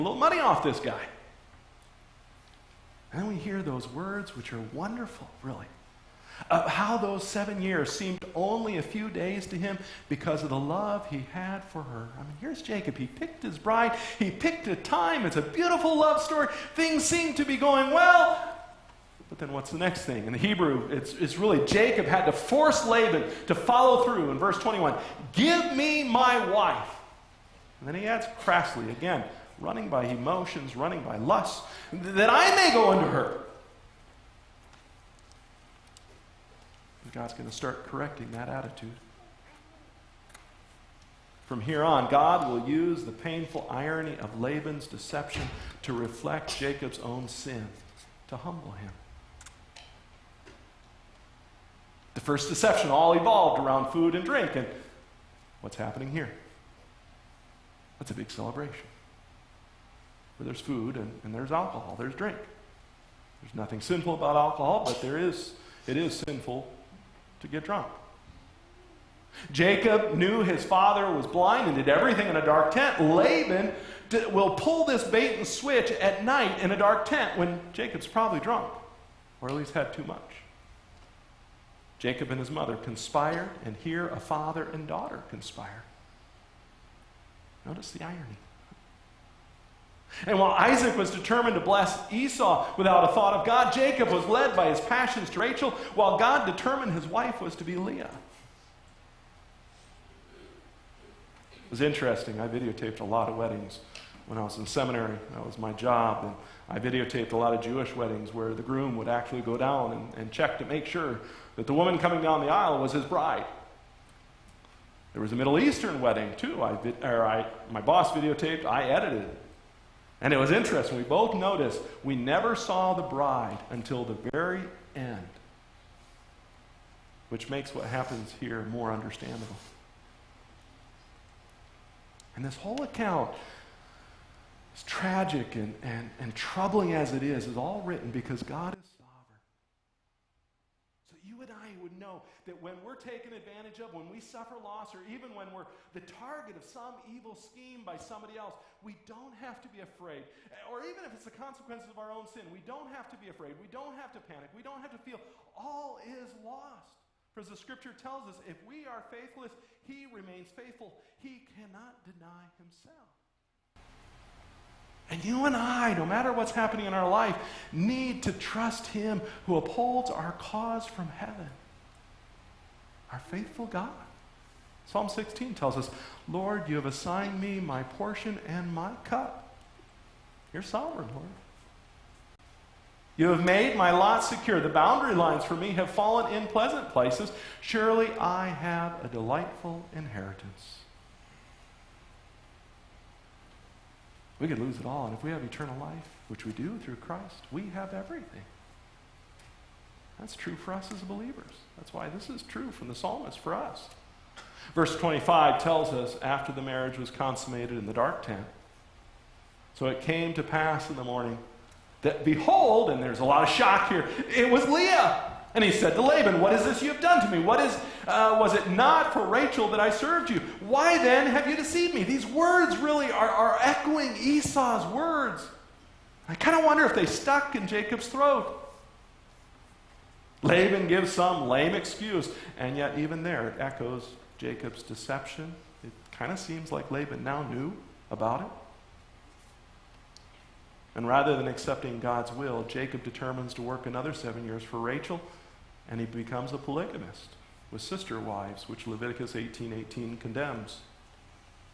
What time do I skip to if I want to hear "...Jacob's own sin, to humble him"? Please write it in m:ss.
0:46.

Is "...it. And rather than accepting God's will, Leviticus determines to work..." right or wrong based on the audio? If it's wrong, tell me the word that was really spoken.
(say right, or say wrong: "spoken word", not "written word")
wrong: "Jacob", not "Leviticus".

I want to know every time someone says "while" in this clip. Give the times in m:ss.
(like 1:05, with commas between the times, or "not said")
1:30, 1:35.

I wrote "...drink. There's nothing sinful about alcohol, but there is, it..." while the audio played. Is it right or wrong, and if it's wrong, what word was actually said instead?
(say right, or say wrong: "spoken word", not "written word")
right.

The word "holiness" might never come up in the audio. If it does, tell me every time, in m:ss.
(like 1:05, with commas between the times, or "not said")
not said.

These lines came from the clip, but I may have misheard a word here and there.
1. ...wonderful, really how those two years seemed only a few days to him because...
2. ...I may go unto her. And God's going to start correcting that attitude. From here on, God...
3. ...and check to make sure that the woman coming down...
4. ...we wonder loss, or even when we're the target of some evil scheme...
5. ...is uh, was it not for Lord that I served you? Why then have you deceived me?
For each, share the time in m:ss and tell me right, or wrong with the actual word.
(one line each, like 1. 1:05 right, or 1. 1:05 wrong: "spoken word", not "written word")
1. 0:04 wrong: "seven", not "two"
2. 0:32 right
3. 1:50 right
4. 2:24 wrong: "suffer", not "wonder"
5. 3:37 wrong: "Rachel", not "Lord".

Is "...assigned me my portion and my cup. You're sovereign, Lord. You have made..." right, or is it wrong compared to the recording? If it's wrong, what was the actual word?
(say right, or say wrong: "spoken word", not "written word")
right.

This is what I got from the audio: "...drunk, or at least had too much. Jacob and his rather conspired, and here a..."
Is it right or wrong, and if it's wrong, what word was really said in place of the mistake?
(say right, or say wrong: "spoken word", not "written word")
wrong: "mother", not "rather".